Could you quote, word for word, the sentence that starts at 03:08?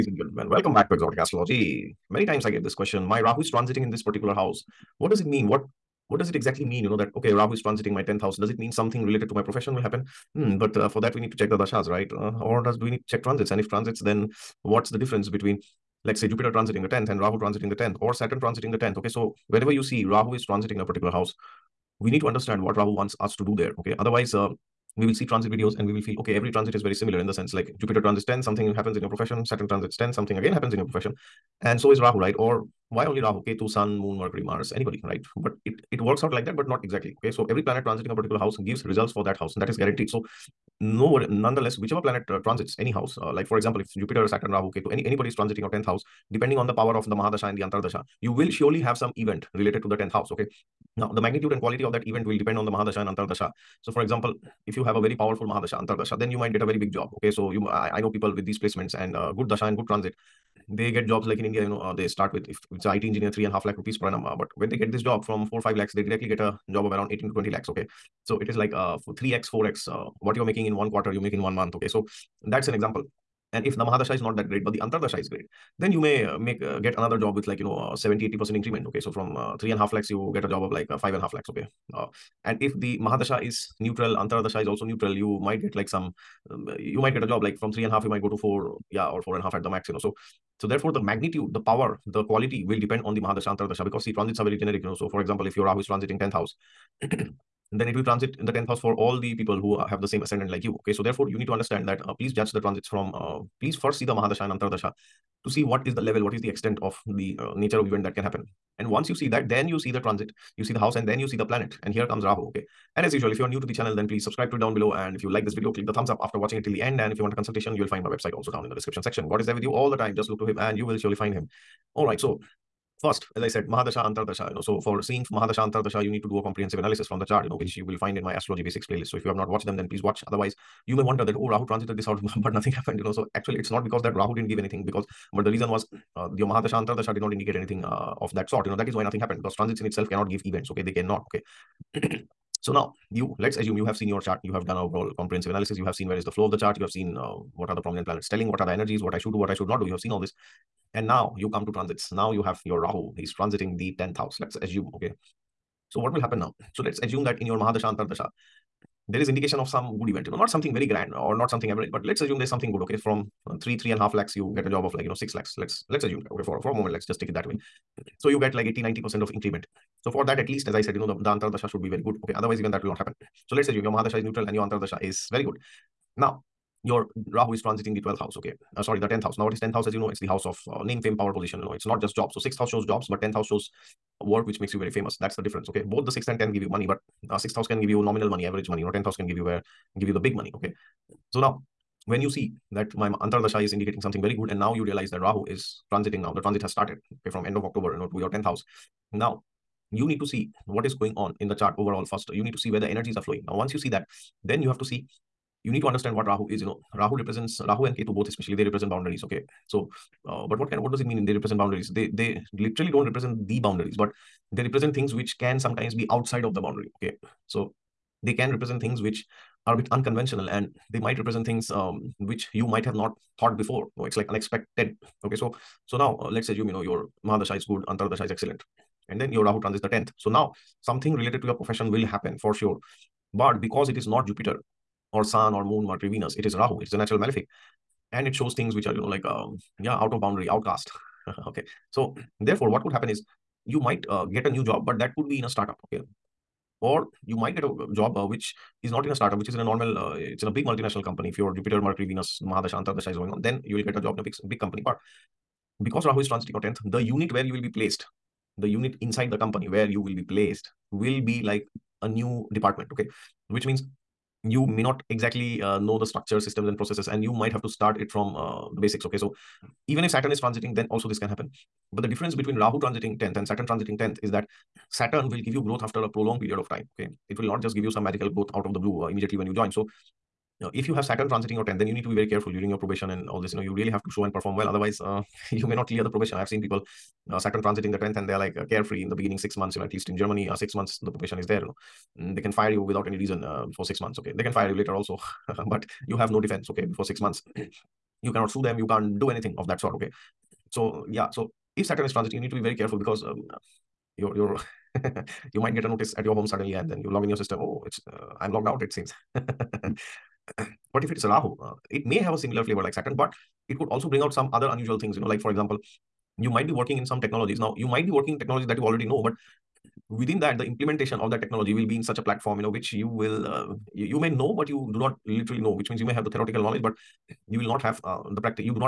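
You know, 10th house can give you where give you the big money.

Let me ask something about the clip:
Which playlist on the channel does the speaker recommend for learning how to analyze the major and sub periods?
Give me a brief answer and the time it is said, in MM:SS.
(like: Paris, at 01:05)
astrology basics, at 02:08.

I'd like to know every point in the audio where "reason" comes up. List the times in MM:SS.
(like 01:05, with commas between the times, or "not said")
02:15, 04:53.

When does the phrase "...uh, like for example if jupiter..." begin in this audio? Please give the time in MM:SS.
00:43.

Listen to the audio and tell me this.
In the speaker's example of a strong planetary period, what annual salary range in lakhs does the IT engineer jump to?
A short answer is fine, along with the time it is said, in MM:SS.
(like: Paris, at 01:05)
18 to 20 lakhs, at 01:07.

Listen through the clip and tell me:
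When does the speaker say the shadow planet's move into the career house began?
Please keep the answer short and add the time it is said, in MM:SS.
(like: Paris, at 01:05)
end of October, at 03:17.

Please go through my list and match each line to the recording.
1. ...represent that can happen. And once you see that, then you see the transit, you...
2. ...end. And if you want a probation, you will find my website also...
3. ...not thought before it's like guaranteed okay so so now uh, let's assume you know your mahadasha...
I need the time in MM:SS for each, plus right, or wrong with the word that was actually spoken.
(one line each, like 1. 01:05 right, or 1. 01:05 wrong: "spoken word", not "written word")
1. 01:47 wrong: "event", not "represent"
2. 01:56 wrong: "consultation", not "probation"
3. 03:42 wrong: "unexpected", not "guaranteed".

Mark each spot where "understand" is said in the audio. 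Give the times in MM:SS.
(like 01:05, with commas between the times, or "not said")
00:22, 01:41, 03:25.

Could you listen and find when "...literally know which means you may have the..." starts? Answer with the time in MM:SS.
05:25.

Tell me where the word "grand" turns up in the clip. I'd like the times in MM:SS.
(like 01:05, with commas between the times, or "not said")
02:40.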